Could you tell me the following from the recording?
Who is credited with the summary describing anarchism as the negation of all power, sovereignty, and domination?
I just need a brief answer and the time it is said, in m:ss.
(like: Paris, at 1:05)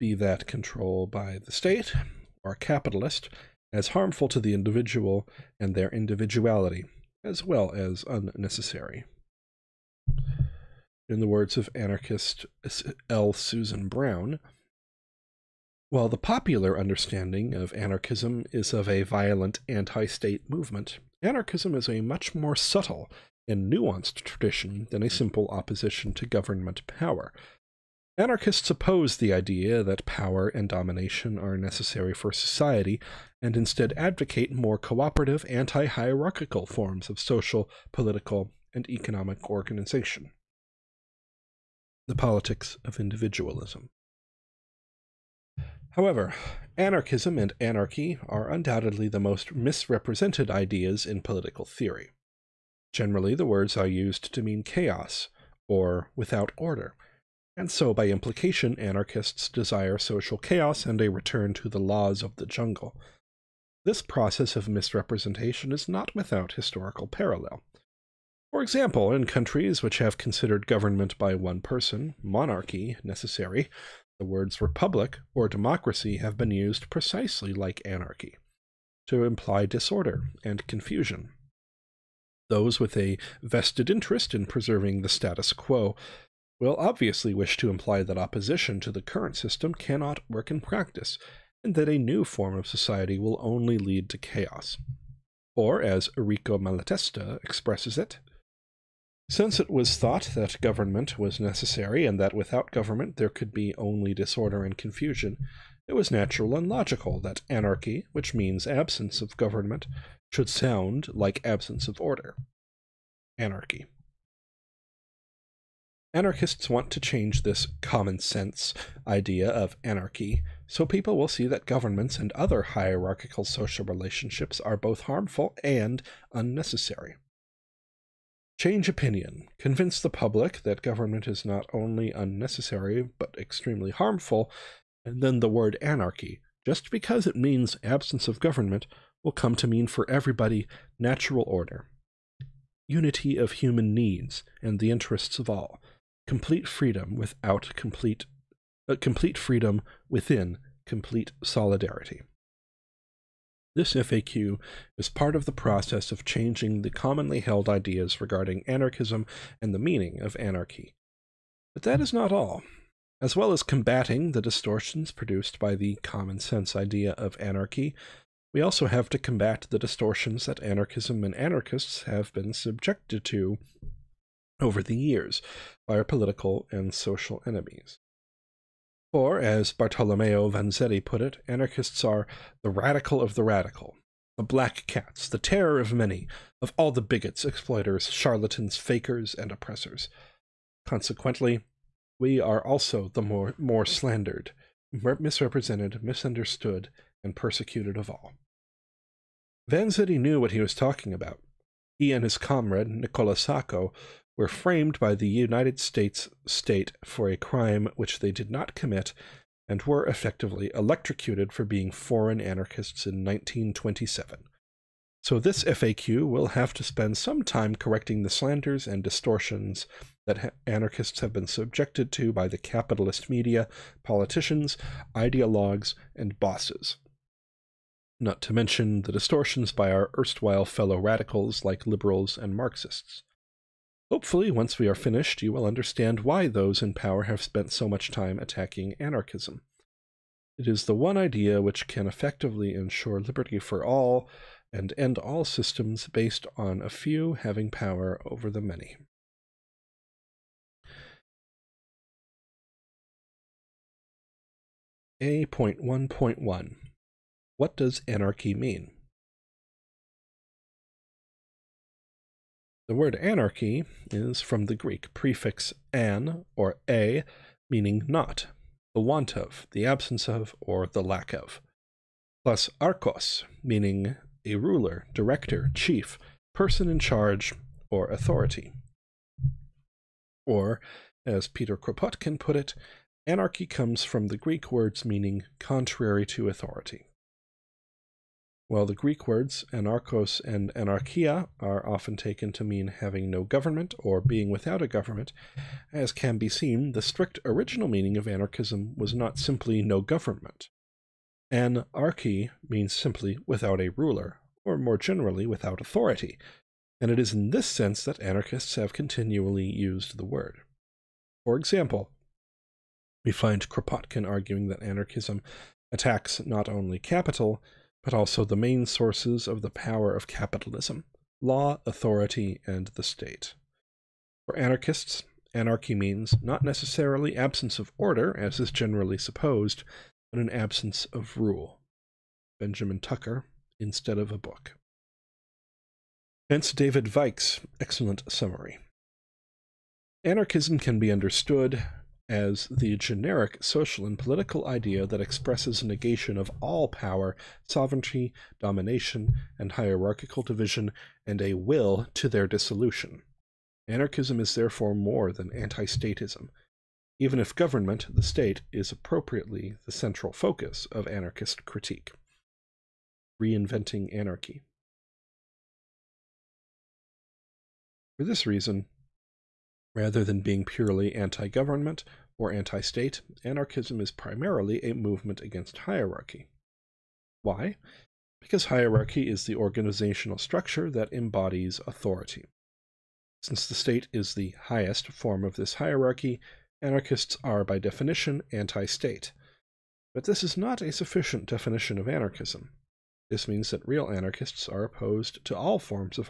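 David Weick, at 5:36.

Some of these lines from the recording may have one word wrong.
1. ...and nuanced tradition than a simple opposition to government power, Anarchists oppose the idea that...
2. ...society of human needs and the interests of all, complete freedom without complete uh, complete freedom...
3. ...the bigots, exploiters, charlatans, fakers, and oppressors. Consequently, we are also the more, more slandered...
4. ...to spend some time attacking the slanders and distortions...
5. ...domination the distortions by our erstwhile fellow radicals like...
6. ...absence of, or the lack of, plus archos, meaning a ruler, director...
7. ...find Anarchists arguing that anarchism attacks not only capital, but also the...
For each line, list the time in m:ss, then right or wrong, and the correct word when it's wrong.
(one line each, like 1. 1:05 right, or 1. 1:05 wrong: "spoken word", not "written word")
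1. 0:23 right
2. 2:22 wrong: "unity", not "society"
3. 3:06 right
4. 3:36 wrong: "correcting", not "attacking"
5. 3:48 wrong: "mention", not "domination"
6. 4:29 right
7. 5:13 wrong: "Kropotkin", not "Anarchists".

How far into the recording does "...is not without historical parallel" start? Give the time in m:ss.
1:05.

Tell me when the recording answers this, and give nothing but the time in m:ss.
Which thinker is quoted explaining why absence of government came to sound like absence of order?
1:36.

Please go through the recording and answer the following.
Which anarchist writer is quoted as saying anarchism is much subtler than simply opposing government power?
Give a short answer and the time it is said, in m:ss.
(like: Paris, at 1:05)
L. Susan Brown, at 0:13.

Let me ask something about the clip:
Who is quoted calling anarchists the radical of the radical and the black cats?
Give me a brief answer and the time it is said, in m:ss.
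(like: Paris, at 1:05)
Bartolomeo Vanzetti, at 2:59.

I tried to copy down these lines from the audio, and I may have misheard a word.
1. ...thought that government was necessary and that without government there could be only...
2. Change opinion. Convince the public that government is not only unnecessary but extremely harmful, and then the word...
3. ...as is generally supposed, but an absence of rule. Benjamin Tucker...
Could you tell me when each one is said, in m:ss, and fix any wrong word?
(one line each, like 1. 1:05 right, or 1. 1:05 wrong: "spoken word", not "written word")
1. 1:39 right
2. 2:08 right
3. 5:28 right.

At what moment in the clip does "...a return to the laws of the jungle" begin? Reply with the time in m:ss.
1:01.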